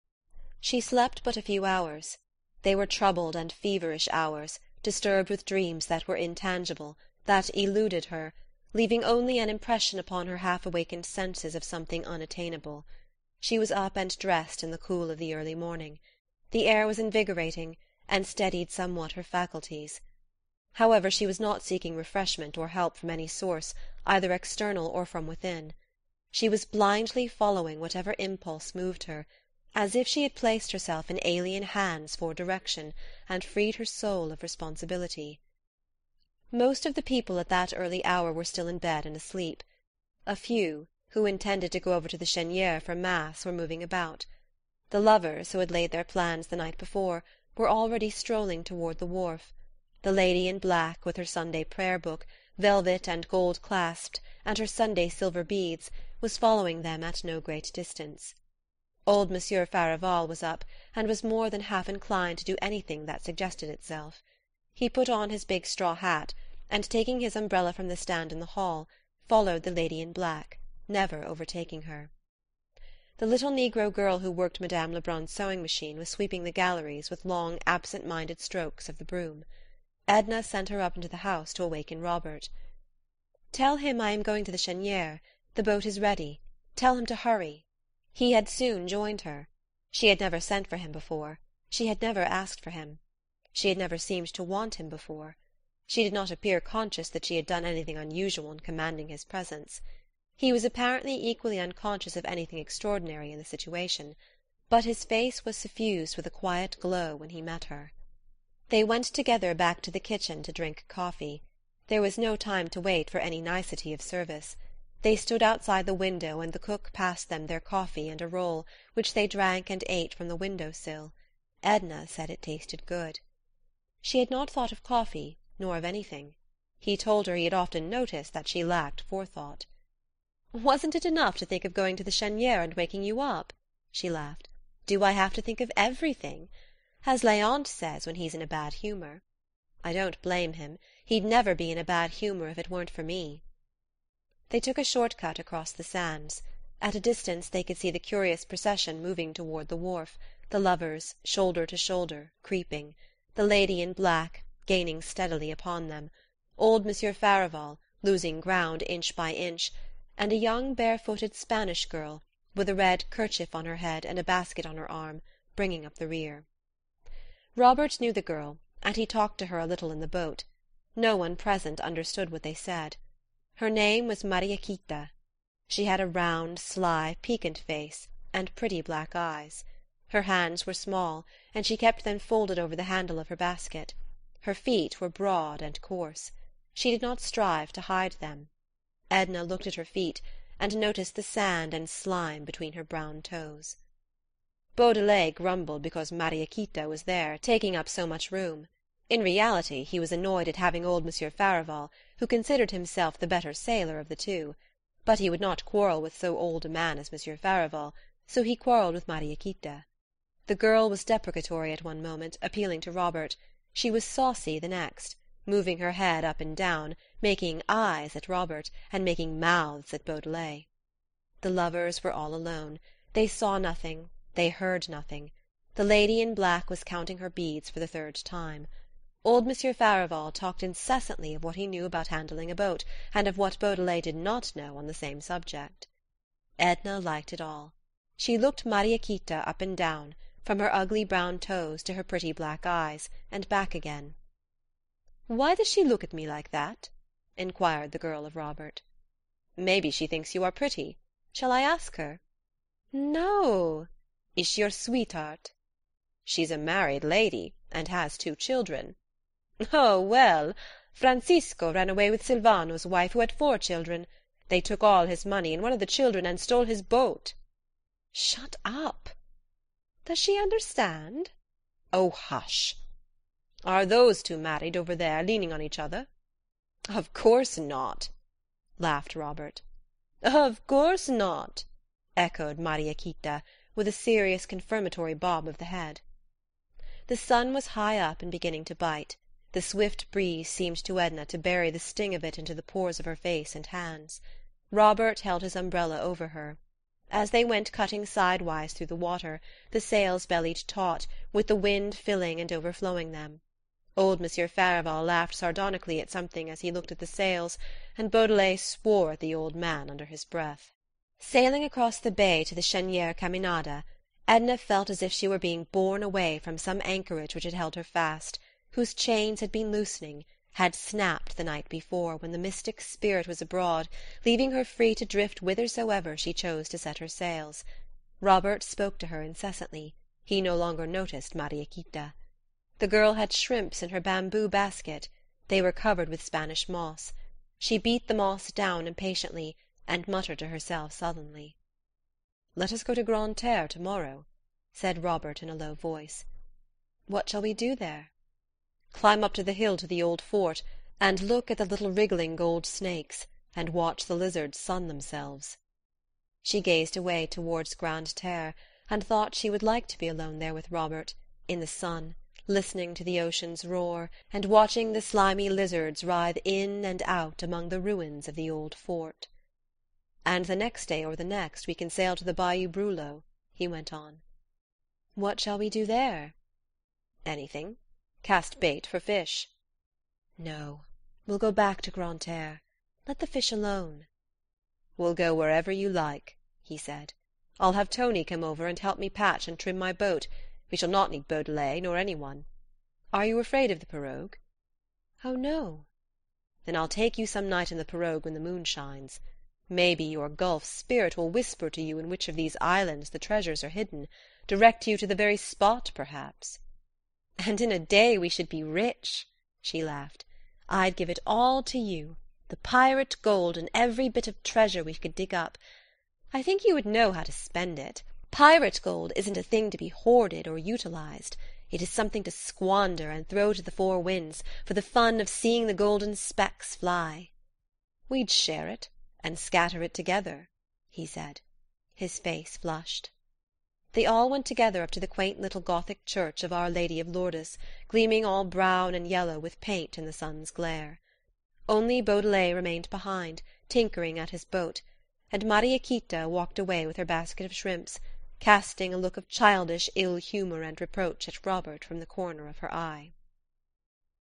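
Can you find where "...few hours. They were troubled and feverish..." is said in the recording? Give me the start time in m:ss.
0:01.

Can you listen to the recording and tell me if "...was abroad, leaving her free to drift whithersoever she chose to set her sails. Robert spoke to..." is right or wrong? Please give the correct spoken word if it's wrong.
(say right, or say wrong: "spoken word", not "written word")
right.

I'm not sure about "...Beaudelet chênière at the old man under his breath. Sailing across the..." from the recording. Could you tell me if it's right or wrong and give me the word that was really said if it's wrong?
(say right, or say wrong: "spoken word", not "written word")
wrong: "swore", not "chênière".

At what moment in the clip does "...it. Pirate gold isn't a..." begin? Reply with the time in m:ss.
6:57.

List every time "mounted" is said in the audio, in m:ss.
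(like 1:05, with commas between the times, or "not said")
not said.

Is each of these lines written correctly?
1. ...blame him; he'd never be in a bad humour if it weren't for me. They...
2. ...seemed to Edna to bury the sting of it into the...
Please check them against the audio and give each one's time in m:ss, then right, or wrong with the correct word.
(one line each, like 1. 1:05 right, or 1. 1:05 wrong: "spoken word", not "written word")
1. 2:20 right
2. 4:50 right.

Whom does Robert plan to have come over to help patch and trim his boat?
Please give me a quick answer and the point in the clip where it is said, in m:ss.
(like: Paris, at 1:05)
Tony, at 6:27.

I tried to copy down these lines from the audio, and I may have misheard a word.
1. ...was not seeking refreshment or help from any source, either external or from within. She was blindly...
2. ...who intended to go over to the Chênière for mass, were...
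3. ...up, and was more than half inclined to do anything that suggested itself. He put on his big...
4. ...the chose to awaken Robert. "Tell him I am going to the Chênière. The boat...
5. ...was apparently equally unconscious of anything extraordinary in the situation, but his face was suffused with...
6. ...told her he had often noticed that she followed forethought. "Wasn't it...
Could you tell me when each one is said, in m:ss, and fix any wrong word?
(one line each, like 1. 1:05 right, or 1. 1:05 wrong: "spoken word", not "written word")
1. 0:21 right
2. 0:41 right
3. 1:00 right
4. 1:21 wrong: "house", not "chose"
5. 1:40 right
6. 2:06 wrong: "lacked", not "followed".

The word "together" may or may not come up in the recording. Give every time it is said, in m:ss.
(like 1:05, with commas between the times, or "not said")
1:49, 7:09, 7:14.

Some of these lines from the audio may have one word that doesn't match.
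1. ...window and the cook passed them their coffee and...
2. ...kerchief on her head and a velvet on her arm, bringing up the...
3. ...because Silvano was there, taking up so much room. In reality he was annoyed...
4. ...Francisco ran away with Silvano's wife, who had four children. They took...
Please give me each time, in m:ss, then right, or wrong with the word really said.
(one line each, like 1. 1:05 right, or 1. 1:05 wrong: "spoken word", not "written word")
1. 1:55 right
2. 2:43 wrong: "basket", not "velvet"
3. 3:15 wrong: "Mariequita", not "Silvano"
4. 4:20 right.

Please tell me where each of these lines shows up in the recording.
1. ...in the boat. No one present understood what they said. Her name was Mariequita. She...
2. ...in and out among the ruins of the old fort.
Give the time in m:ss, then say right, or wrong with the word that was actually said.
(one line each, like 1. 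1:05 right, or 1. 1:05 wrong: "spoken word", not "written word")
1. 2:49 right
2. 6:06 right.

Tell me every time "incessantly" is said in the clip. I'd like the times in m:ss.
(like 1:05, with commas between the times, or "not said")
3:50, 5:29.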